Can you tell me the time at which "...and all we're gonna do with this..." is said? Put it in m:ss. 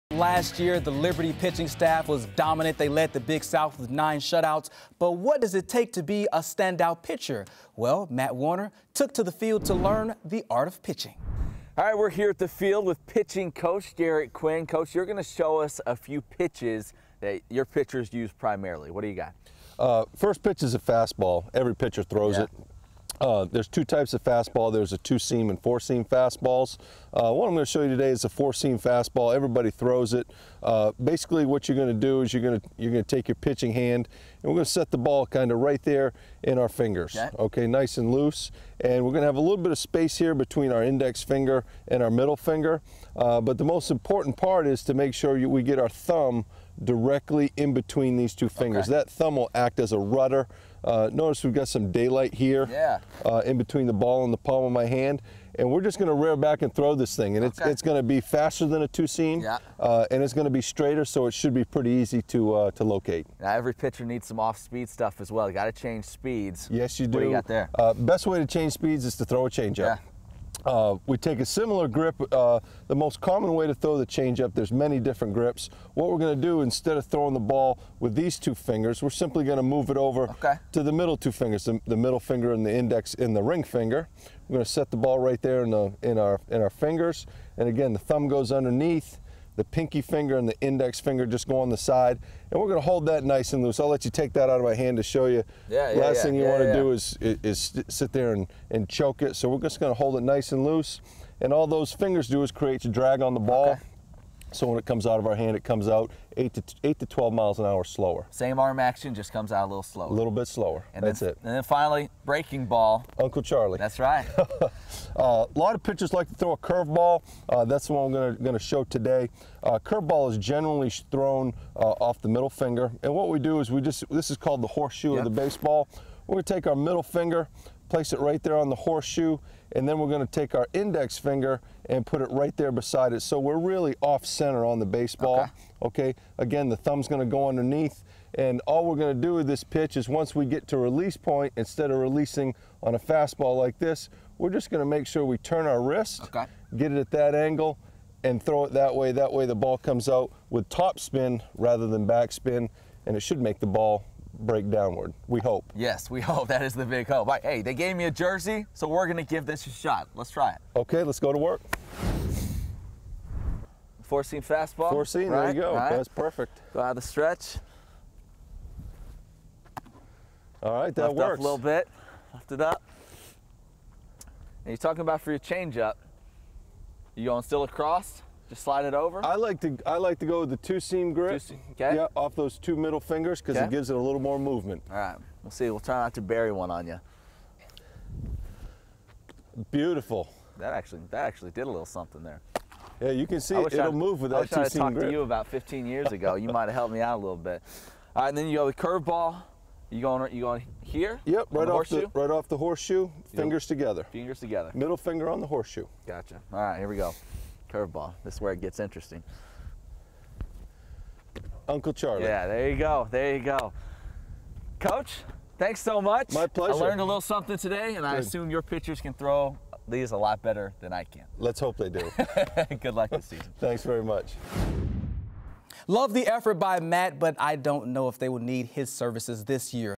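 2:18.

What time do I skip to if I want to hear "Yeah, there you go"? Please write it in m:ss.
3:32.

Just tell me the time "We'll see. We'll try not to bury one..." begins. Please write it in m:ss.
3:05.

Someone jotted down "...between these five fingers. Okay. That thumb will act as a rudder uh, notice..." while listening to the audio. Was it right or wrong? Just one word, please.
wrong.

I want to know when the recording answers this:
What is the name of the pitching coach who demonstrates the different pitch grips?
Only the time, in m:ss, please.
0:13.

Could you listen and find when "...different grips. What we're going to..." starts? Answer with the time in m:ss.
1:14.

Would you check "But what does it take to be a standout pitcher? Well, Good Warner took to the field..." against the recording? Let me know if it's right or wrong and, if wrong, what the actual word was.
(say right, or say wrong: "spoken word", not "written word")
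wrong: "Matt", not "Good".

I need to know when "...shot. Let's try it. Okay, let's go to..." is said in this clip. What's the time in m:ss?
2:39.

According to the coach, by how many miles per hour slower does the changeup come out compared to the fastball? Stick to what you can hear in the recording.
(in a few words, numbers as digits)
8 to 12.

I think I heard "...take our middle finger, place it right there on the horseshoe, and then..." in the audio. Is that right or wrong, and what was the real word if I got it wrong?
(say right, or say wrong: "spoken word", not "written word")
right.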